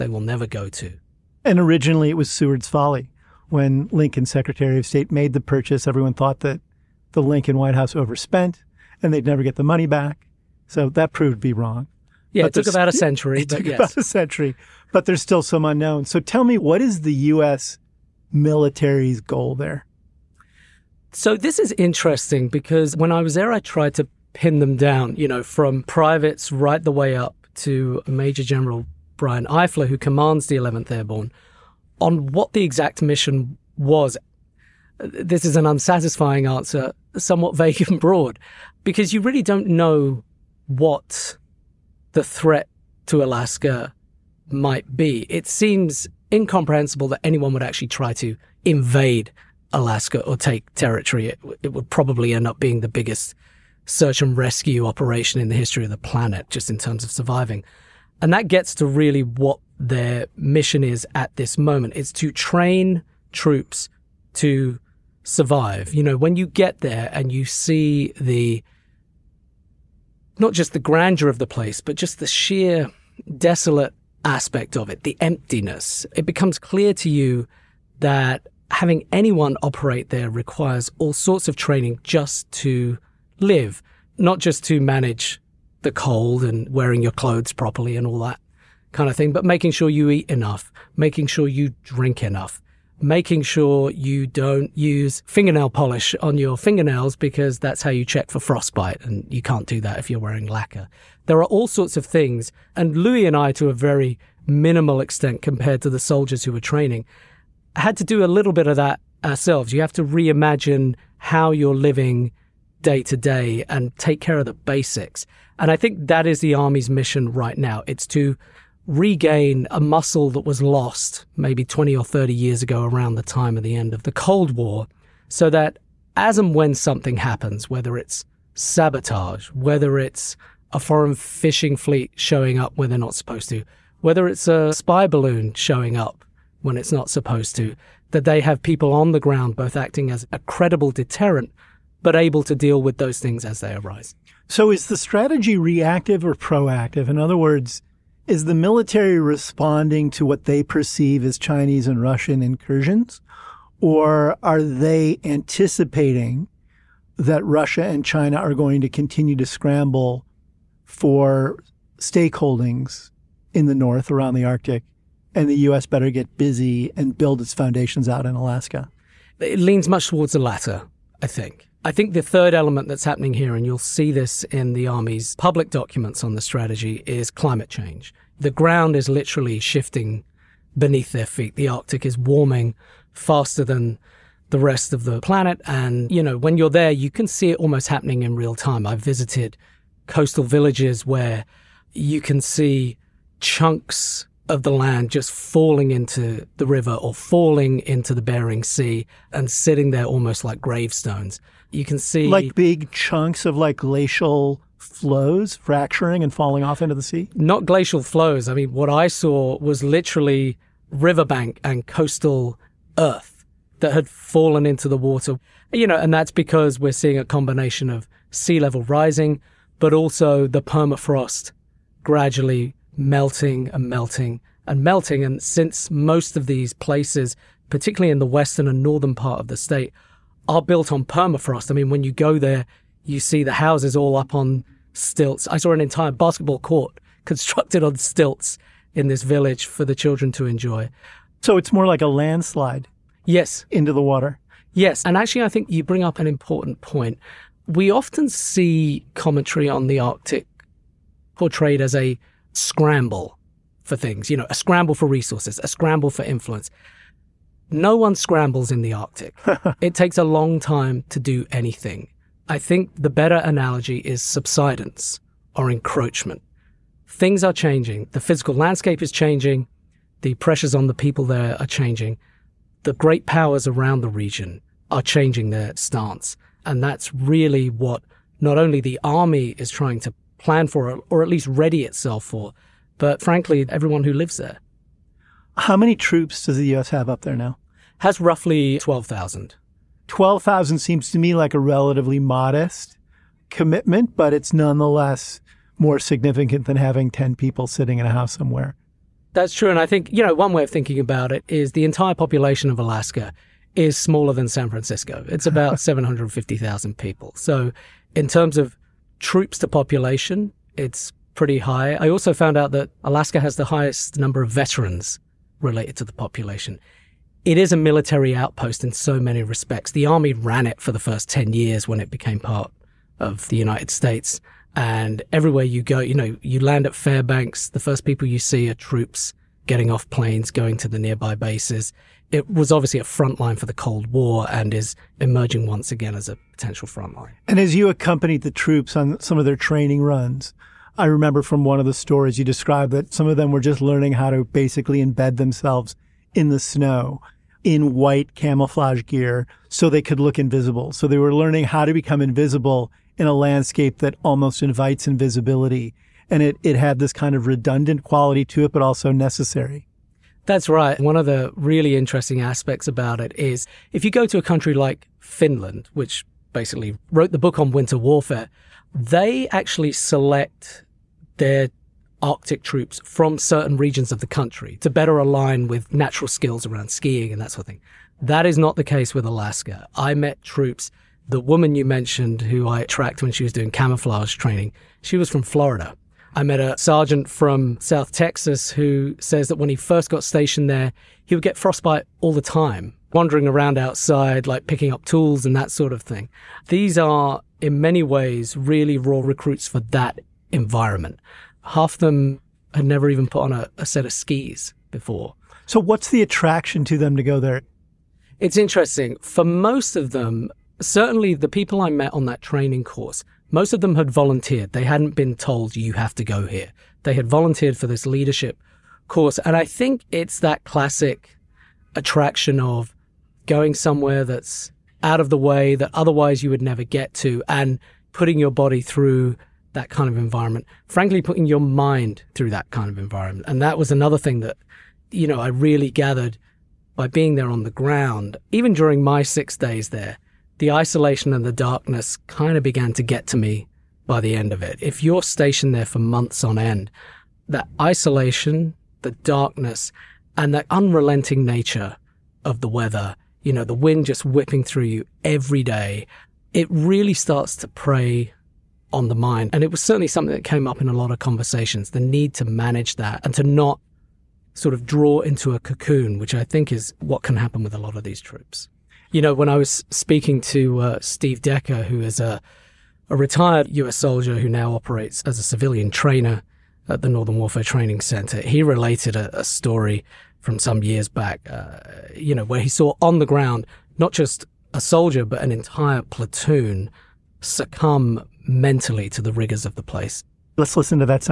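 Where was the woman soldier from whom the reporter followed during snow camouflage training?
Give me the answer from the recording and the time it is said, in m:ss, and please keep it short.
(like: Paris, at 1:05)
Florida, at 6:25.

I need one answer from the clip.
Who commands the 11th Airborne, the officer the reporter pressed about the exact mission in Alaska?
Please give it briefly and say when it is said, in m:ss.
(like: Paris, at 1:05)
Brian Eifler, at 0:29.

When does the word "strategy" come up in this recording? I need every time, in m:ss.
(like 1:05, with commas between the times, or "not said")
2:24, 2:56.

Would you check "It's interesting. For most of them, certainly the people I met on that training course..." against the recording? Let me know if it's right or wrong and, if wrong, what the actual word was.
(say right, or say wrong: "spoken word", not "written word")
right.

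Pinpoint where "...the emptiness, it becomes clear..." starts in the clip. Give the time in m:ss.
1:15.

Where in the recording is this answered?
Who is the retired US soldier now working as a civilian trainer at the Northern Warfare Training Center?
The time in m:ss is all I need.
7:50.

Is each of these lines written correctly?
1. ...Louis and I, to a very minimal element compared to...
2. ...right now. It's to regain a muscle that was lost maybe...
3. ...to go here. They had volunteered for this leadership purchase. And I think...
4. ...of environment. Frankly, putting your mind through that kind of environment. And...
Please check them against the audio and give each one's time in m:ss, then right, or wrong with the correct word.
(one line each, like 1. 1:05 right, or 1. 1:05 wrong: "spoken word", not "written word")
1. 1:42 wrong: "extent", not "element"
2. 1:57 right
3. 6:56 wrong: "course", not "purchase"
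4. 7:10 right.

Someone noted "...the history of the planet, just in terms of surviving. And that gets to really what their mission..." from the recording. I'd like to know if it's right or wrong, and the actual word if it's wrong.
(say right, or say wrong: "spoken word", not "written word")
right.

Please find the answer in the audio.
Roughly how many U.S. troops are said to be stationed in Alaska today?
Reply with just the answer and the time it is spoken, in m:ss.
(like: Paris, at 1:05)
12,000, at 4:48.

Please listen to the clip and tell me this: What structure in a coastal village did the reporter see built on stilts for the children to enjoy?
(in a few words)
Basketball court.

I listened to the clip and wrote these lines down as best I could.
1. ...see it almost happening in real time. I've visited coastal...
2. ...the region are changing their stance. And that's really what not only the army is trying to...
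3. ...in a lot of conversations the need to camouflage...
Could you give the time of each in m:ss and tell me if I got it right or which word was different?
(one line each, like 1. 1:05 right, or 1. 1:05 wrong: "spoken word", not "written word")
1. 3:07 right
2. 4:33 right
3. 7:40 wrong: "manage", not "camouflage".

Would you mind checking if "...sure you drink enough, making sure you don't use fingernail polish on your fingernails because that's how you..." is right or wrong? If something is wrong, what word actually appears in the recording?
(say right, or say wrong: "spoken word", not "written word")
right.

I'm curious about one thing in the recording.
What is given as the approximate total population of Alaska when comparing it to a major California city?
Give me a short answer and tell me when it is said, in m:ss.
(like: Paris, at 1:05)
750,000, at 5:05.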